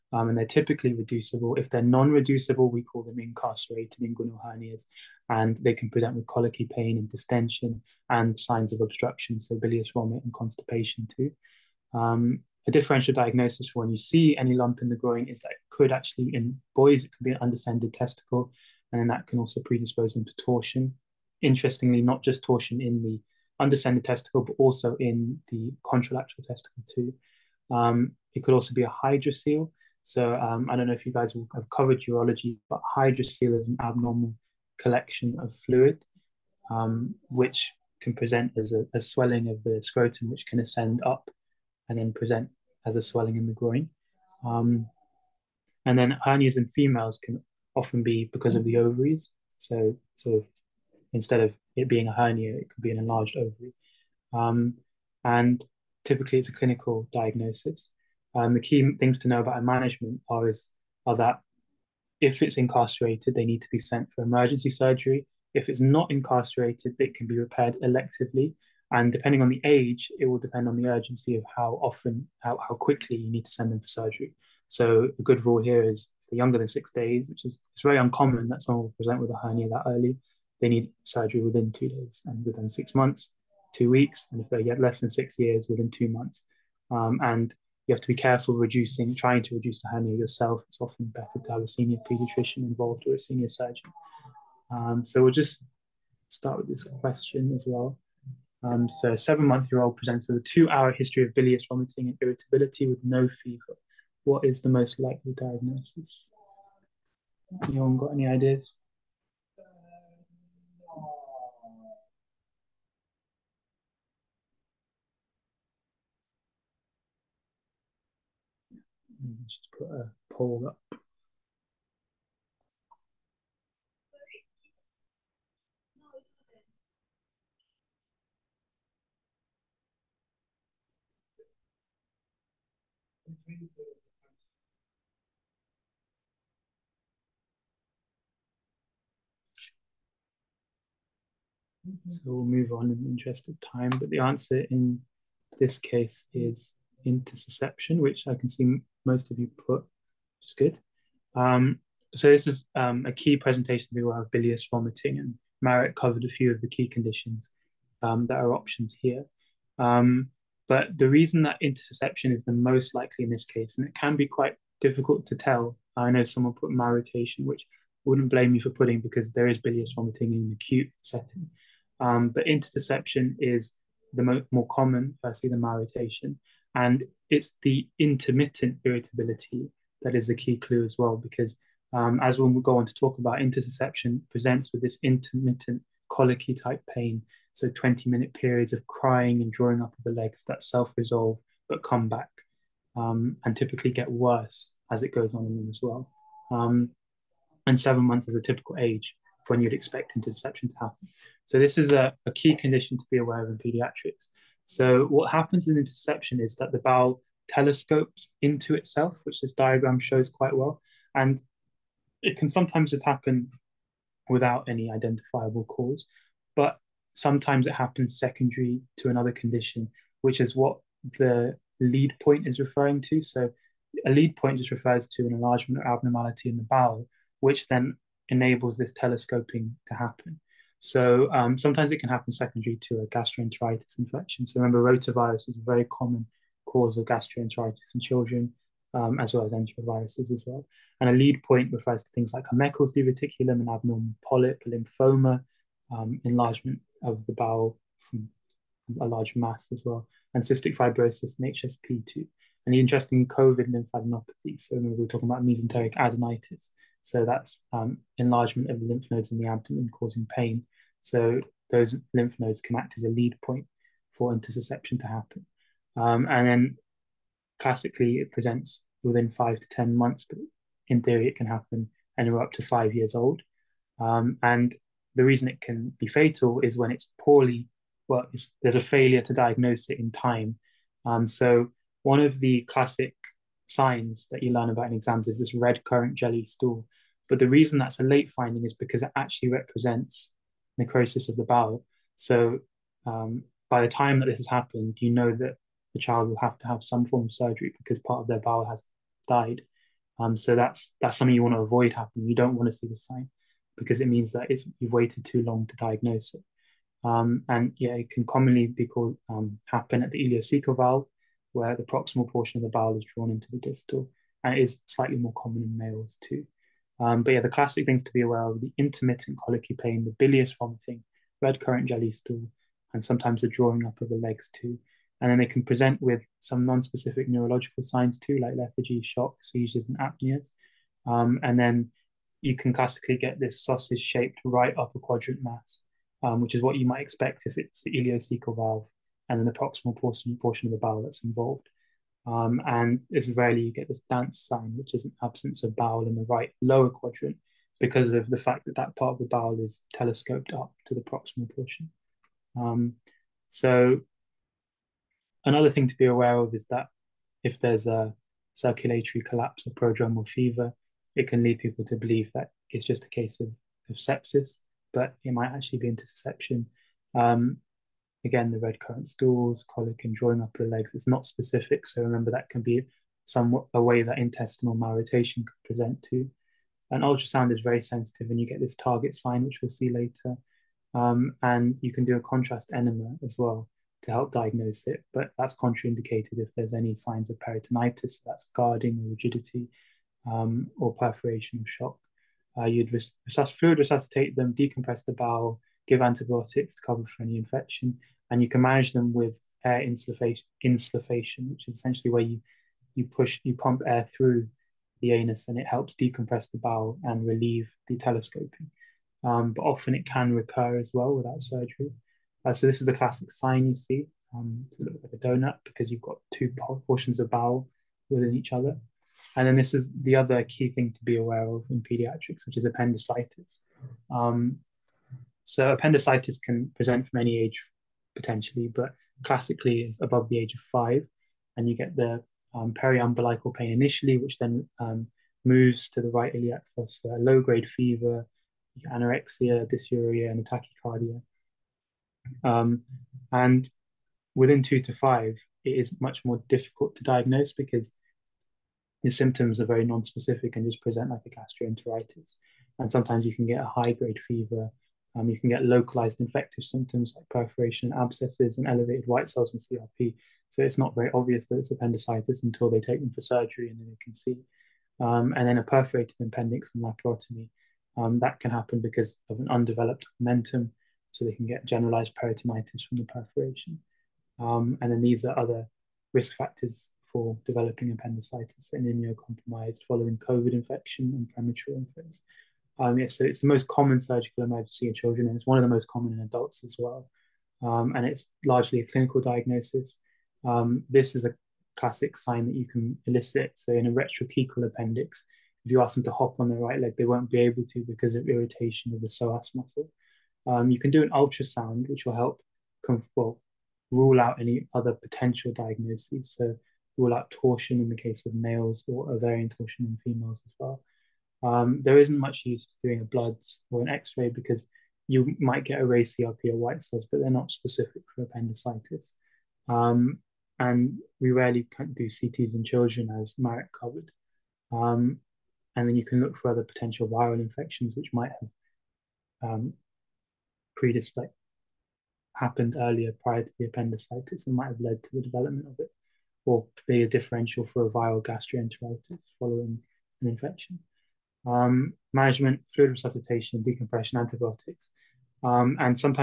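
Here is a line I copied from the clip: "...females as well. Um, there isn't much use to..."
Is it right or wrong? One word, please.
right.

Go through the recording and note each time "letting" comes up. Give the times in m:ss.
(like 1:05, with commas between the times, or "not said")
not said.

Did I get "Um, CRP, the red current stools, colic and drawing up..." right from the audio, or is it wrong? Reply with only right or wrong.
wrong.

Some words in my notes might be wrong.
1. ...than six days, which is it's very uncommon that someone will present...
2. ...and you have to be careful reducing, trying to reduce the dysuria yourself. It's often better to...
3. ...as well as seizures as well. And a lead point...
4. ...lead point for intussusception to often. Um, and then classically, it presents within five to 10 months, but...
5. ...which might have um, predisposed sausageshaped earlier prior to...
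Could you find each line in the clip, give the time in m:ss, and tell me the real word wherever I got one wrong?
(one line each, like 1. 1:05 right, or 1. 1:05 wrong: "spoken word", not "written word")
1. 1:16 right
2. 1:27 wrong: "hernia", not "dysuria"
3. 3:59 wrong: "enteroviruses", not "seizures"
4. 4:23 wrong: "happen", not "often"
5. 8:47 wrong: "happened", not "sausageshaped".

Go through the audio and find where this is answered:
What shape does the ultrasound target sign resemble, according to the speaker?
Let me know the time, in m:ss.
6:55.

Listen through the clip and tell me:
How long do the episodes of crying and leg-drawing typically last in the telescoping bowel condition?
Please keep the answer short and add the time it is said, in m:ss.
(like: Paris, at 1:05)
20 minutes, at 3:07.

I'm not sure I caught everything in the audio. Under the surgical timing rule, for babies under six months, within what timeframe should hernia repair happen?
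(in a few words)
2 weeks.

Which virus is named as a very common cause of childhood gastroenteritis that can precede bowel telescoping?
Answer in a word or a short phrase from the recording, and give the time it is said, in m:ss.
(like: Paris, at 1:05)
Rotavirus, at 3:54.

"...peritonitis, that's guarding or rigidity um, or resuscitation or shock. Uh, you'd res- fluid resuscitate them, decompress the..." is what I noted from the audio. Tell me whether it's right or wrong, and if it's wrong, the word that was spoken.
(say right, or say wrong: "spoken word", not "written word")
wrong: "perforation", not "resuscitation".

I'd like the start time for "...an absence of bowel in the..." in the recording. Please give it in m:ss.
5:45.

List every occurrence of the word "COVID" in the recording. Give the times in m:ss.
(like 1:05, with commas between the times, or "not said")
4:13, 8:00.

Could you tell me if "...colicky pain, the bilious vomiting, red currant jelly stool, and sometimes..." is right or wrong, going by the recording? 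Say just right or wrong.
right.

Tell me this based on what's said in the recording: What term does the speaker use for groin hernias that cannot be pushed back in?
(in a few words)
Incarcerated inguinal hernias.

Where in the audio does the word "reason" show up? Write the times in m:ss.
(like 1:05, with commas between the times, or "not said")
2:41, 4:35, 4:47.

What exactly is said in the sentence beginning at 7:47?
Um, that can happen because of an undeveloped omentum, so they can get generalized peritonitis from the perforation.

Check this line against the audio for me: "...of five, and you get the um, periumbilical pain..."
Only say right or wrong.
right.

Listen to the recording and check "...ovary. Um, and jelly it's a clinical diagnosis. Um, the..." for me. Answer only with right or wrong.
wrong.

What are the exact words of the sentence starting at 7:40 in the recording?
So it's not very obvious that it's appendicitis until they take them for surgery and then they can see.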